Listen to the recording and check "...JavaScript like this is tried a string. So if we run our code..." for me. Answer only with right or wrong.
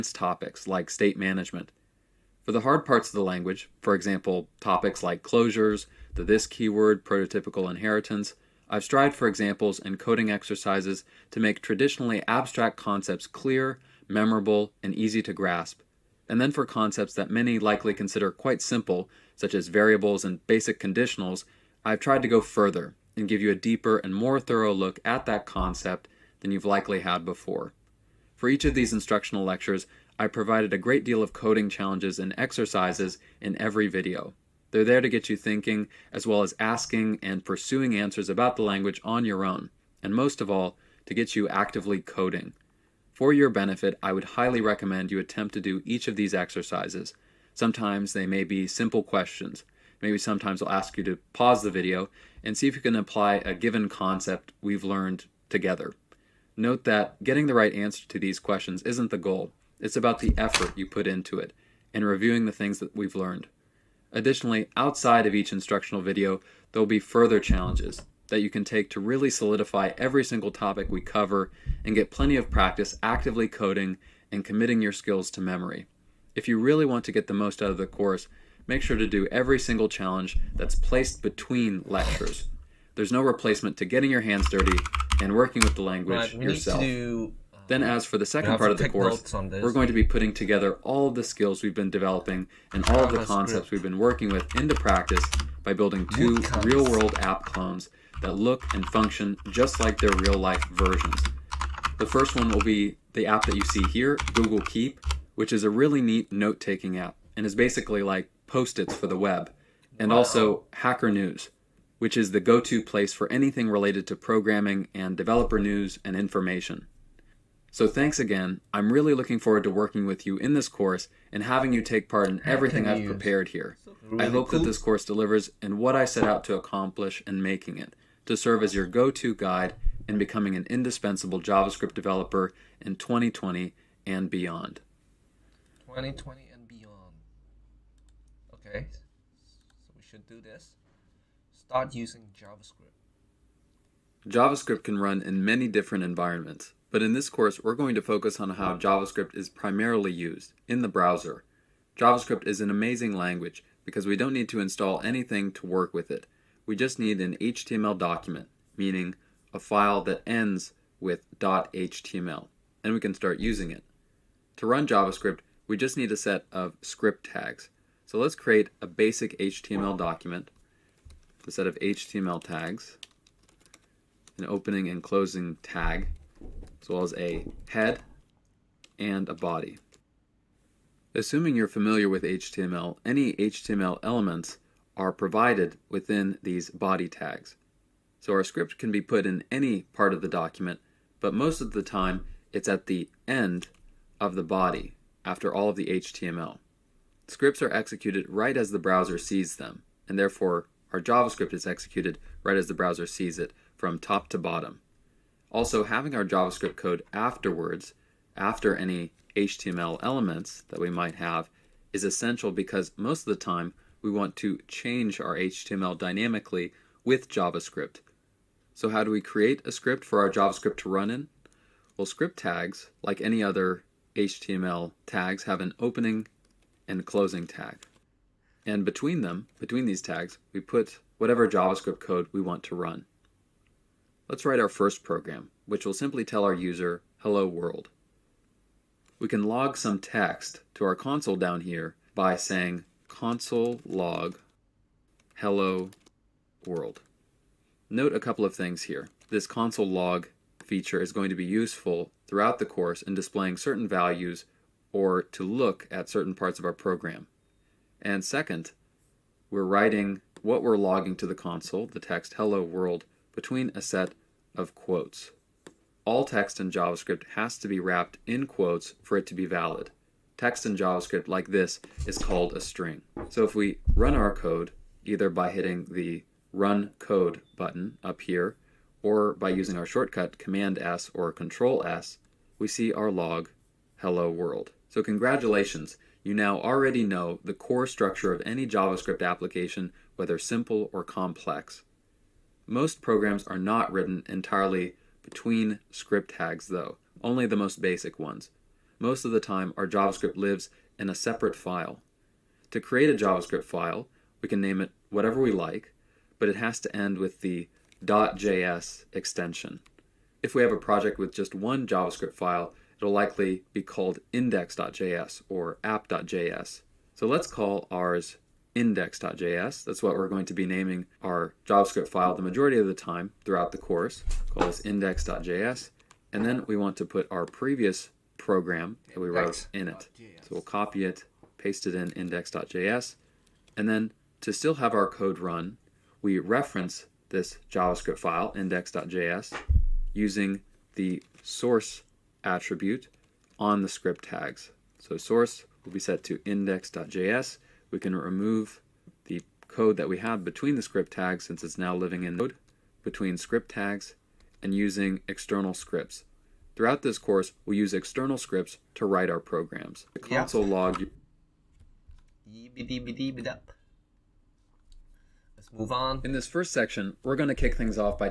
wrong.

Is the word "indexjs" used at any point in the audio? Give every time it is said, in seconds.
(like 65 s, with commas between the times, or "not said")
314 s, 318 s, 324 s, 332 s, 338 s, 346 s.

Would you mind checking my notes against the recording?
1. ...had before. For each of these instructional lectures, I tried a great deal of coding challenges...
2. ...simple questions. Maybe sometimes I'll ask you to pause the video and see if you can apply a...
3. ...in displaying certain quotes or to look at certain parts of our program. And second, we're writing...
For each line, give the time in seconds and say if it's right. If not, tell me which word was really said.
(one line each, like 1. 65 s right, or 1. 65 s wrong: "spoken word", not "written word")
1. 26 s wrong: "provided", not "tried"
2. 48 s right
3. 253 s wrong: "values", not "quotes".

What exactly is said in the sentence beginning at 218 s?
So how do we create a script for our JavaScript to run in?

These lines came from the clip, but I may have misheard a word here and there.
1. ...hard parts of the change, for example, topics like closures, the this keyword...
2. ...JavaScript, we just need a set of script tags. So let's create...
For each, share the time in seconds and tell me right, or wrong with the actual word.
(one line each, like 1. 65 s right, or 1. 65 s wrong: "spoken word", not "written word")
1. 2 s wrong: "language", not "change"
2. 164 s right.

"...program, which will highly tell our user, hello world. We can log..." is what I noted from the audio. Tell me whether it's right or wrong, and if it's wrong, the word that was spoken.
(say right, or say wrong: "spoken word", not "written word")
wrong: "simply", not "highly".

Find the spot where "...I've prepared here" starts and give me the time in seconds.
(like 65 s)
122 s.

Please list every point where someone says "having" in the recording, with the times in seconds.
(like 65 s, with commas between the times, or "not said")
121 s, 205 s.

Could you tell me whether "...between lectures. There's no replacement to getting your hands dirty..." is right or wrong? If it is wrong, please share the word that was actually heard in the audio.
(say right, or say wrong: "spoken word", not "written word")
right.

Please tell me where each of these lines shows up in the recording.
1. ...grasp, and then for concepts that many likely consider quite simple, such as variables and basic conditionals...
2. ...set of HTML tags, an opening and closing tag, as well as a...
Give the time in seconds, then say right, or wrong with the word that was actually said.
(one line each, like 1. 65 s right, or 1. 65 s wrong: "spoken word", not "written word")
1. 15 s right
2. 171 s right.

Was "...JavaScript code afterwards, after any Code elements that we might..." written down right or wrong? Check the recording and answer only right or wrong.
wrong.